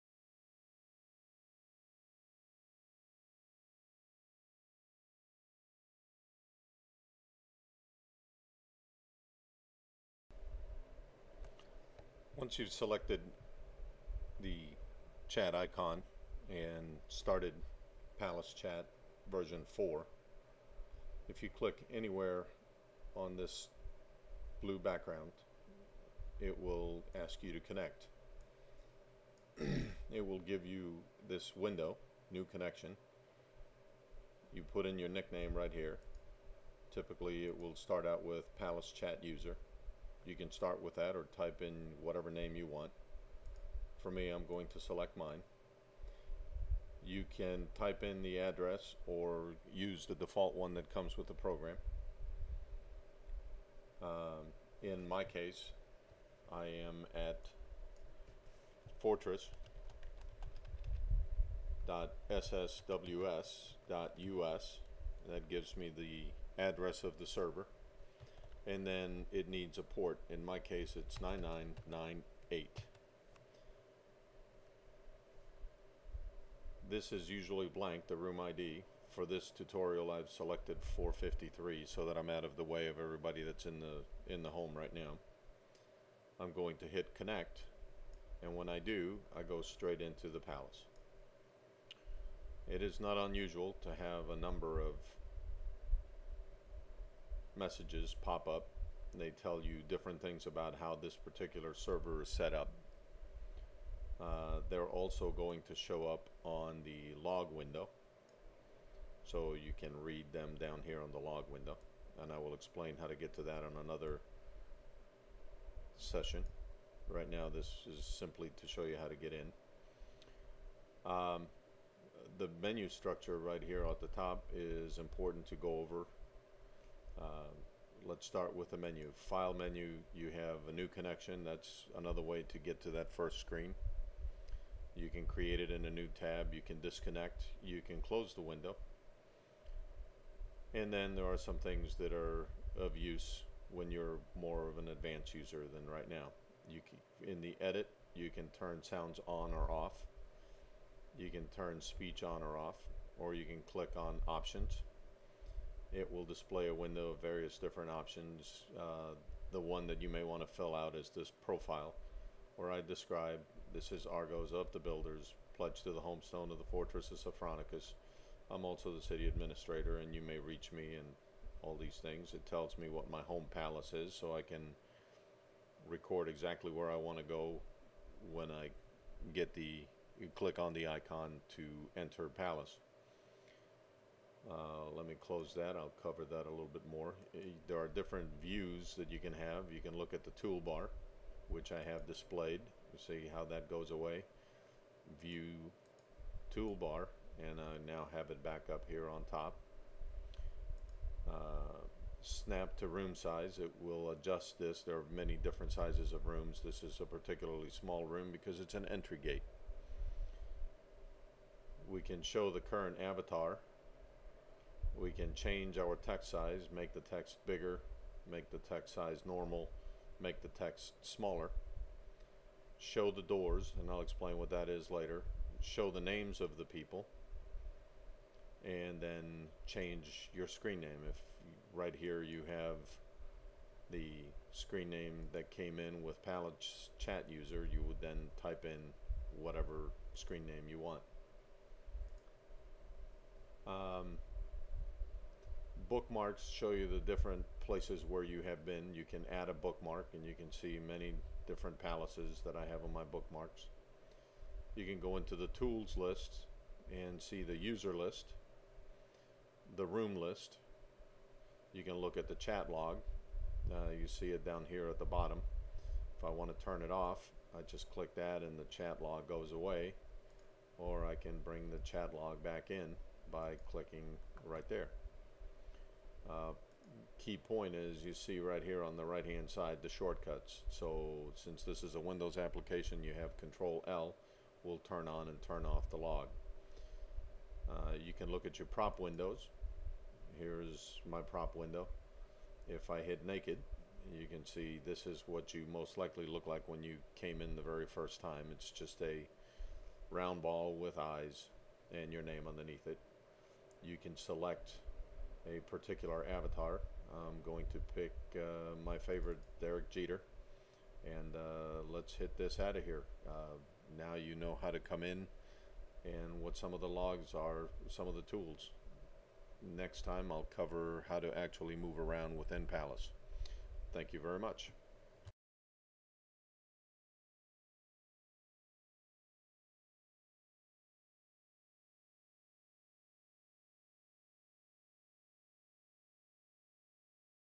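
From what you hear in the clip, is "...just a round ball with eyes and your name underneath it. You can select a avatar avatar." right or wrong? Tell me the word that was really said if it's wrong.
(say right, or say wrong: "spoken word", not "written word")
wrong: "particular", not "avatar".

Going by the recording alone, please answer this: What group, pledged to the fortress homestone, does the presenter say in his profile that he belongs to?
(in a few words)
the Builders.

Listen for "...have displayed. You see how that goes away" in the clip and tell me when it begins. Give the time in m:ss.
3:11.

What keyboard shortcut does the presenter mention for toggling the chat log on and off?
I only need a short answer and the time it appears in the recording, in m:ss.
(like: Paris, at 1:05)
Control L, at 4:43.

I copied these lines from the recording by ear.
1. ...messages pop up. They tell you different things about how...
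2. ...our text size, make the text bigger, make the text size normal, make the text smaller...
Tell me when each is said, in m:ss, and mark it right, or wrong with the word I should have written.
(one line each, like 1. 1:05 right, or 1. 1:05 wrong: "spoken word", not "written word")
1. 1:37 right
2. 3:35 right.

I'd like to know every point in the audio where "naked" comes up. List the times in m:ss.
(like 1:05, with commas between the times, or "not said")
4:53.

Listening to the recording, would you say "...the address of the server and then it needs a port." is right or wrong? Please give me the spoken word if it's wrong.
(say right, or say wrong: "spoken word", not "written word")
right.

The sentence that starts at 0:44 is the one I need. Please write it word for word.
For me, I'm going to select mine.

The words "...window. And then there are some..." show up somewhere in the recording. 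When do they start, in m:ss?
2:18.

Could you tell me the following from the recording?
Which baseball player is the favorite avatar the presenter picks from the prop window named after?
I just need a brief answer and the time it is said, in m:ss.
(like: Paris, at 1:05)
Derek Jeter, at 5:09.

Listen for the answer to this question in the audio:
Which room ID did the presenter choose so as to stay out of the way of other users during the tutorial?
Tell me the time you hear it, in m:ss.
1:20.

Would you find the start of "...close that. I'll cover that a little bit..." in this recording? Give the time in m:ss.
3:05.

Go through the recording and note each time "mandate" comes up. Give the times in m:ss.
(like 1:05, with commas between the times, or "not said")
not said.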